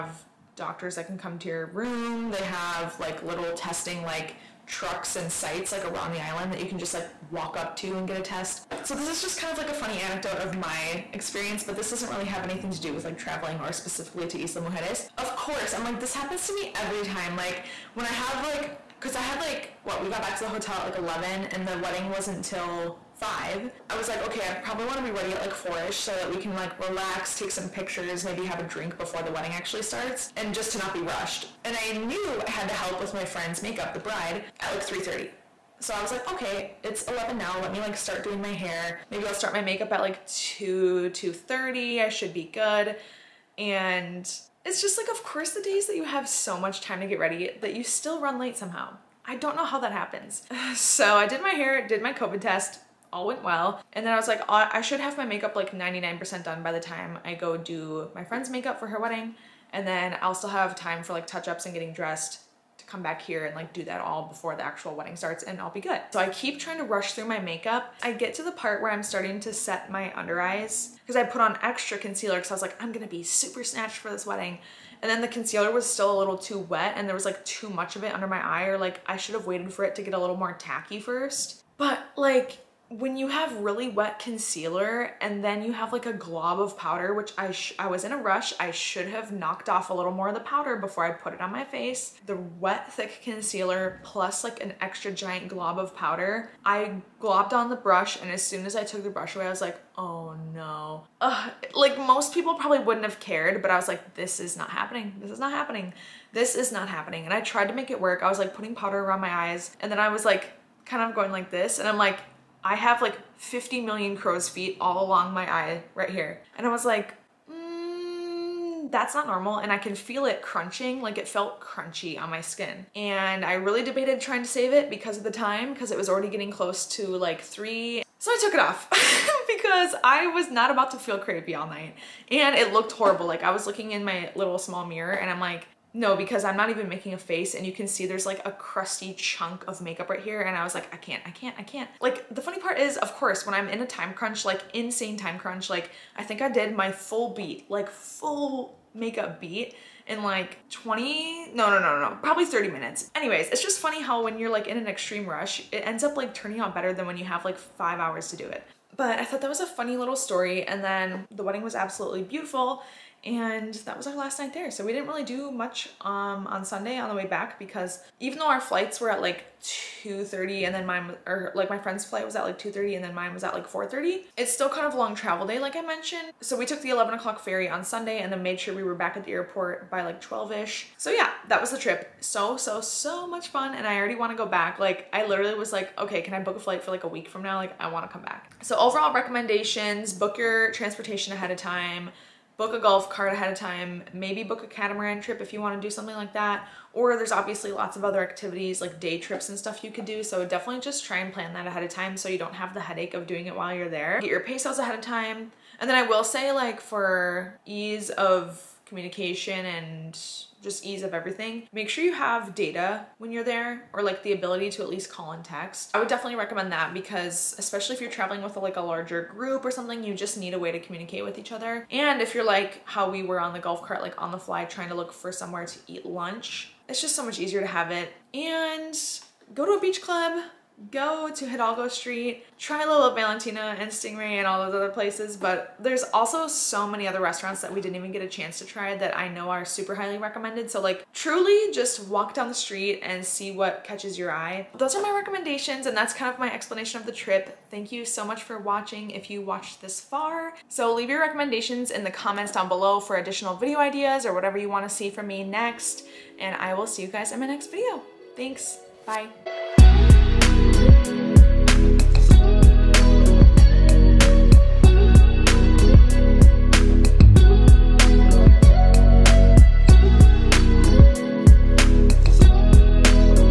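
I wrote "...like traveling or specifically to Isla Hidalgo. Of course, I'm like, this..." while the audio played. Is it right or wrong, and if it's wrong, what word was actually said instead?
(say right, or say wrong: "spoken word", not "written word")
wrong: "Mujeres", not "Hidalgo".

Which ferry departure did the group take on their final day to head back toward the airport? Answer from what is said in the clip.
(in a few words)
11 o'clock.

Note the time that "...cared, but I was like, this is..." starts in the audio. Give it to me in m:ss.
1:43.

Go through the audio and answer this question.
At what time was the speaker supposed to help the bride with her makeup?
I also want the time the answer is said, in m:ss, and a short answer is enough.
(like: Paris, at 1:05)
3:30, at 0:34.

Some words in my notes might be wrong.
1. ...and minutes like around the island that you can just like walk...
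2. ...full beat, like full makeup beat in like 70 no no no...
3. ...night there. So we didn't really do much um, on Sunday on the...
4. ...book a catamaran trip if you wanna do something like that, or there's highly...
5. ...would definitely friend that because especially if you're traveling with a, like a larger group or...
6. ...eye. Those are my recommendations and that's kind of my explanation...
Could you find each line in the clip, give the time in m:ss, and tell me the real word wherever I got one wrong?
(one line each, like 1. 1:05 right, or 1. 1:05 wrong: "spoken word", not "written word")
1. 0:05 wrong: "sites", not "minutes"
2. 2:26 wrong: "20", not "70"
3. 2:44 right
4. 3:14 wrong: "obviously", not "highly"
5. 3:35 wrong: "recommend", not "friend"
6. 4:04 right.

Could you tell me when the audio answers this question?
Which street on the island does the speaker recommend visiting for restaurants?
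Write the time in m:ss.
3:51.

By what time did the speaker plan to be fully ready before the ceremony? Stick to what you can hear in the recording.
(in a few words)
4.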